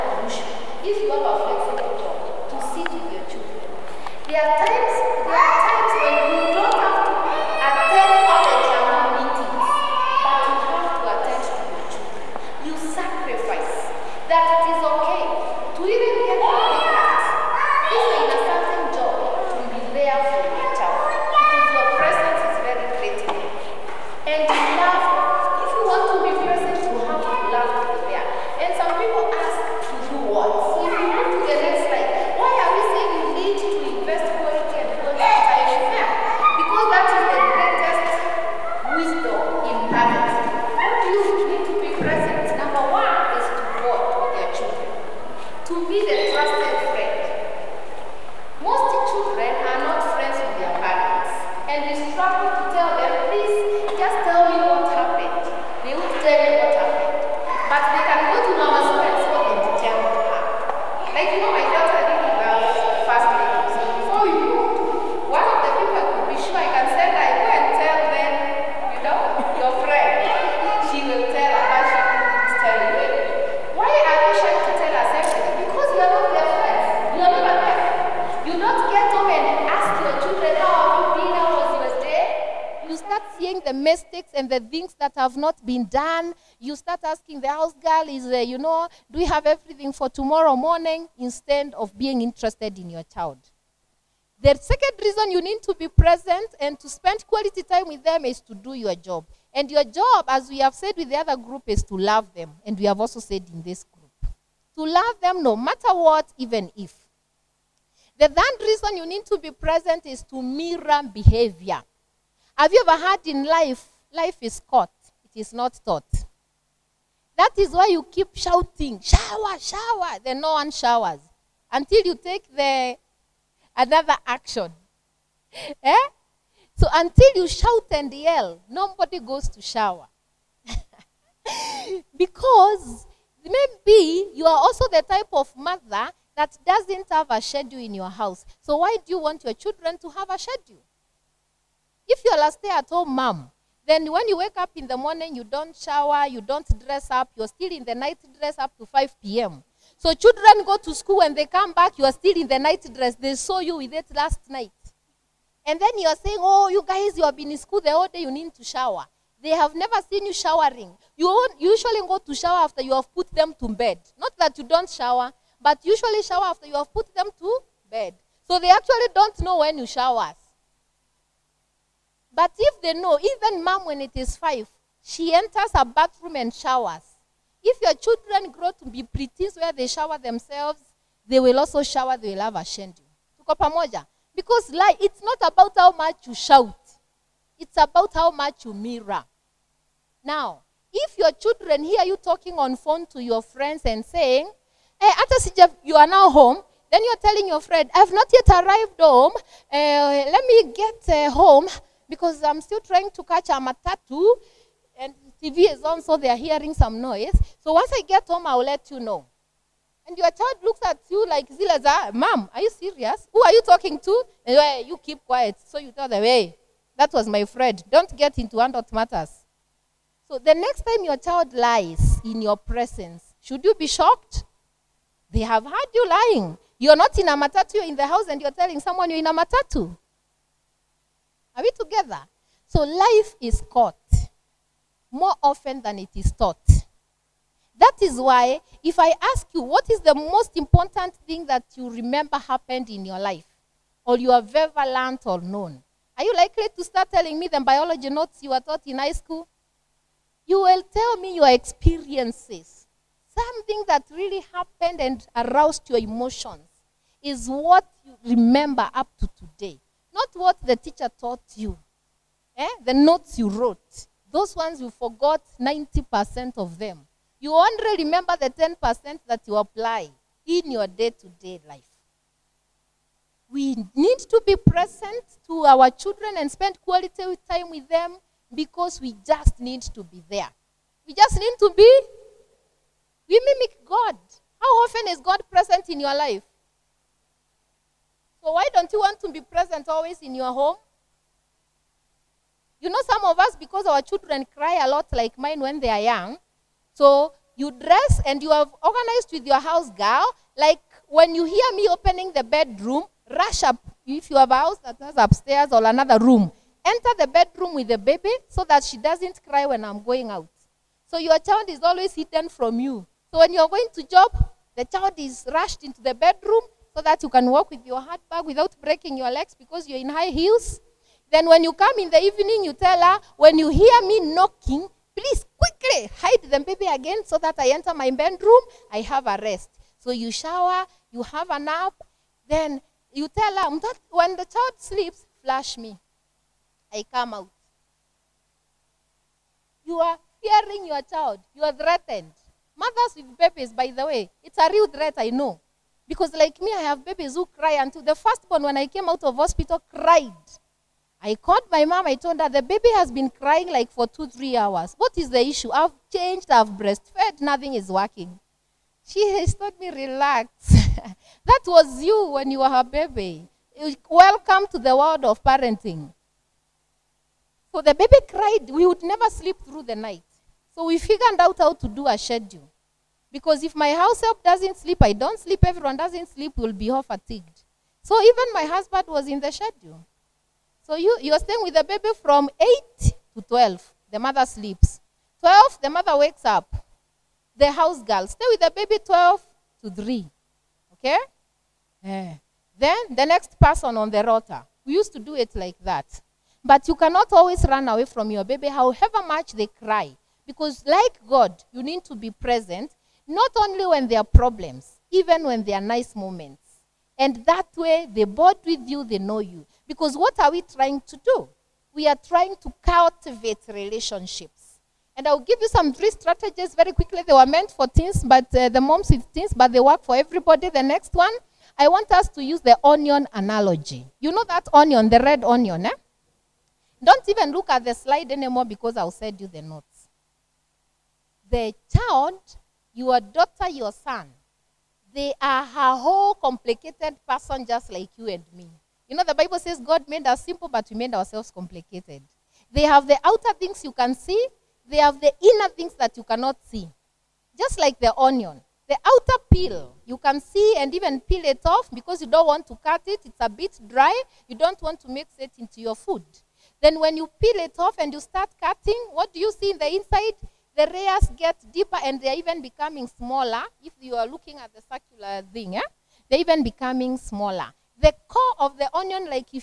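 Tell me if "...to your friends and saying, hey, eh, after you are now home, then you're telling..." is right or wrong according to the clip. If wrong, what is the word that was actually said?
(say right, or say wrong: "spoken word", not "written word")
right.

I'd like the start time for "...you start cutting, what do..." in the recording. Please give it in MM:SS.
07:38.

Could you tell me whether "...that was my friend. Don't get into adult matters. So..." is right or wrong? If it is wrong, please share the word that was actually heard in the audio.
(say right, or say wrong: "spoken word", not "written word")
right.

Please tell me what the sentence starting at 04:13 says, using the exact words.
Something that really happened and aroused your emotions is what you remember up to today.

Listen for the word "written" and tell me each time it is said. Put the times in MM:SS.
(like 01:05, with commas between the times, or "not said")
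not said.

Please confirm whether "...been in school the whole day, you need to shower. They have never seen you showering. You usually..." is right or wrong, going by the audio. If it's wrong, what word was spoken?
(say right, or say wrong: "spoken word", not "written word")
right.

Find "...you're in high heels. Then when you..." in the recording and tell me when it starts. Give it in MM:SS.
05:19.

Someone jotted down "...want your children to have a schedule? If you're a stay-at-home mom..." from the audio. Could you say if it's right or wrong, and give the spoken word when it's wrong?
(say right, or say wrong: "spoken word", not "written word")
right.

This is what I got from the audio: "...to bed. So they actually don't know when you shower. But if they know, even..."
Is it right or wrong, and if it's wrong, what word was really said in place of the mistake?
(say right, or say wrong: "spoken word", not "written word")
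right.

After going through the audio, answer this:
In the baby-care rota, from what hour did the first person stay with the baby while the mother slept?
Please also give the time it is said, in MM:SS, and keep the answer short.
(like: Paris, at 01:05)
8, at 06:23.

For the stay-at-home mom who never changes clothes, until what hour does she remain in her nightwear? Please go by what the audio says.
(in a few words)
5 p.m.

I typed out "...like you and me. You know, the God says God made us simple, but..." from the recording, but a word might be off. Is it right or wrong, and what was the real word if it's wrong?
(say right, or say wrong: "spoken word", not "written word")
wrong: "Bible", not "God".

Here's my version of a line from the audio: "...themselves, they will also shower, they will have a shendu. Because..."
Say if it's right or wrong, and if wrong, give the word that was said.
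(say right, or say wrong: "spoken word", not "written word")
right.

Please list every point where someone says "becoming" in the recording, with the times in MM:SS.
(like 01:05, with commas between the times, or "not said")
07:42, 07:46.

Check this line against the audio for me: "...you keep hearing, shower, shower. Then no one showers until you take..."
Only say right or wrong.
wrong.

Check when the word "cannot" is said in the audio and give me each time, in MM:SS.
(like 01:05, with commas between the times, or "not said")
06:36, 07:26.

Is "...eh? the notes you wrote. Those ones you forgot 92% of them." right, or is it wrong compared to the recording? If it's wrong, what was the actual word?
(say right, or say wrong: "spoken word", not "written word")
wrong: "90", not "92".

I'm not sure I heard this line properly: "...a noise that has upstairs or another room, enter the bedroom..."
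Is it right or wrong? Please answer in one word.
wrong.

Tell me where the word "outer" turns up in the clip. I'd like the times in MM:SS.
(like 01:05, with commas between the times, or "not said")
07:23, 07:28.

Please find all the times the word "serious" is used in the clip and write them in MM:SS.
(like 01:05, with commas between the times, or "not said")
03:32.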